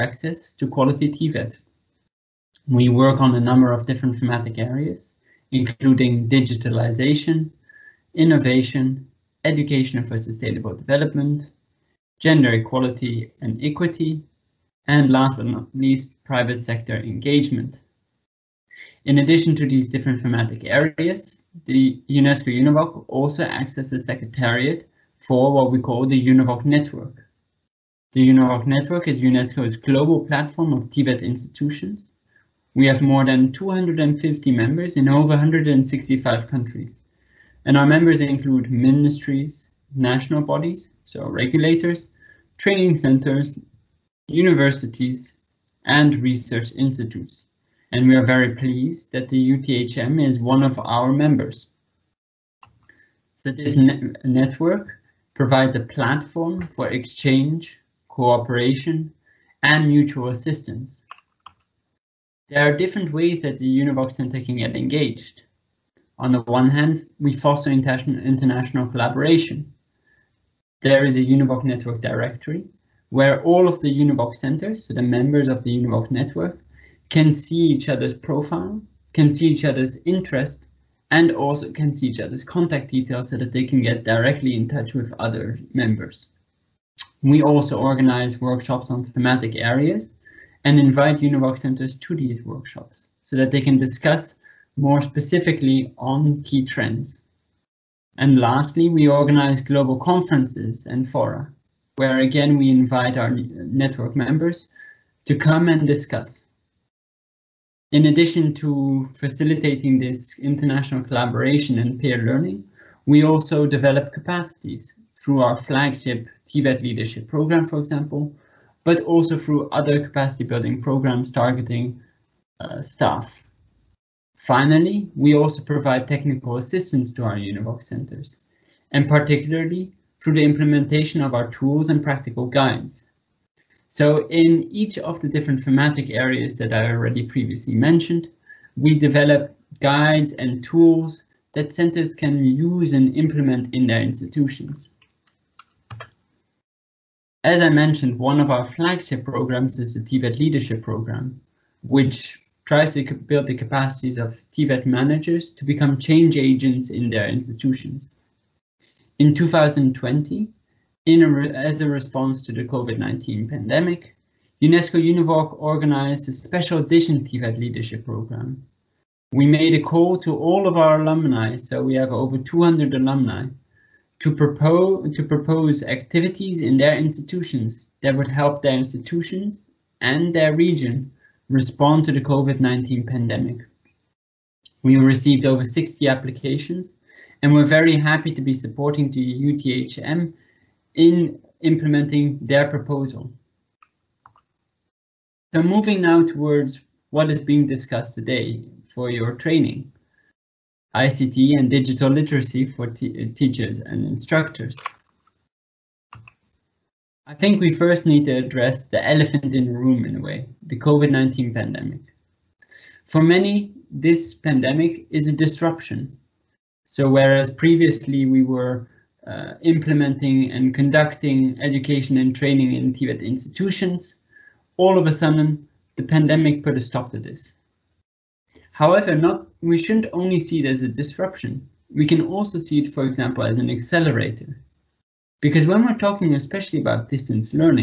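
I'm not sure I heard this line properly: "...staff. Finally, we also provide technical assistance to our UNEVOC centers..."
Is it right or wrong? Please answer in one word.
right.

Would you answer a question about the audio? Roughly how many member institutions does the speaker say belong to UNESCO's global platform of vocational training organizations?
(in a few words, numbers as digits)
more than 250.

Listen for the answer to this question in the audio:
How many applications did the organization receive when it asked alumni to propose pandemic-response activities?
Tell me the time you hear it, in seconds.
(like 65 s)
185 s.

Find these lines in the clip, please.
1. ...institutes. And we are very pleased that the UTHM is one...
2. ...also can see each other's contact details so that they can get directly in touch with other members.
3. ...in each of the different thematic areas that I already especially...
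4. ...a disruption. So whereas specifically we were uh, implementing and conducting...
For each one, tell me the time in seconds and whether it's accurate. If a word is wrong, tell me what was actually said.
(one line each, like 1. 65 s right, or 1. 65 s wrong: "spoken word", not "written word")
1. 46 s right
2. 81 s right
3. 134 s wrong: "previously", not "especially"
4. 215 s wrong: "previously", not "specifically".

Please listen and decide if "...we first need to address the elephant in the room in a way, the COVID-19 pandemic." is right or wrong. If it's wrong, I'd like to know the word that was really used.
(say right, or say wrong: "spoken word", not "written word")
right.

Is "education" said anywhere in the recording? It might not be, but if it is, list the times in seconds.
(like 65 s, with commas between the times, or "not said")
9 s, 221 s.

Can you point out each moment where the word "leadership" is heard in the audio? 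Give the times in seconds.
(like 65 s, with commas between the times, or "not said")
116 s, 150 s, 167 s.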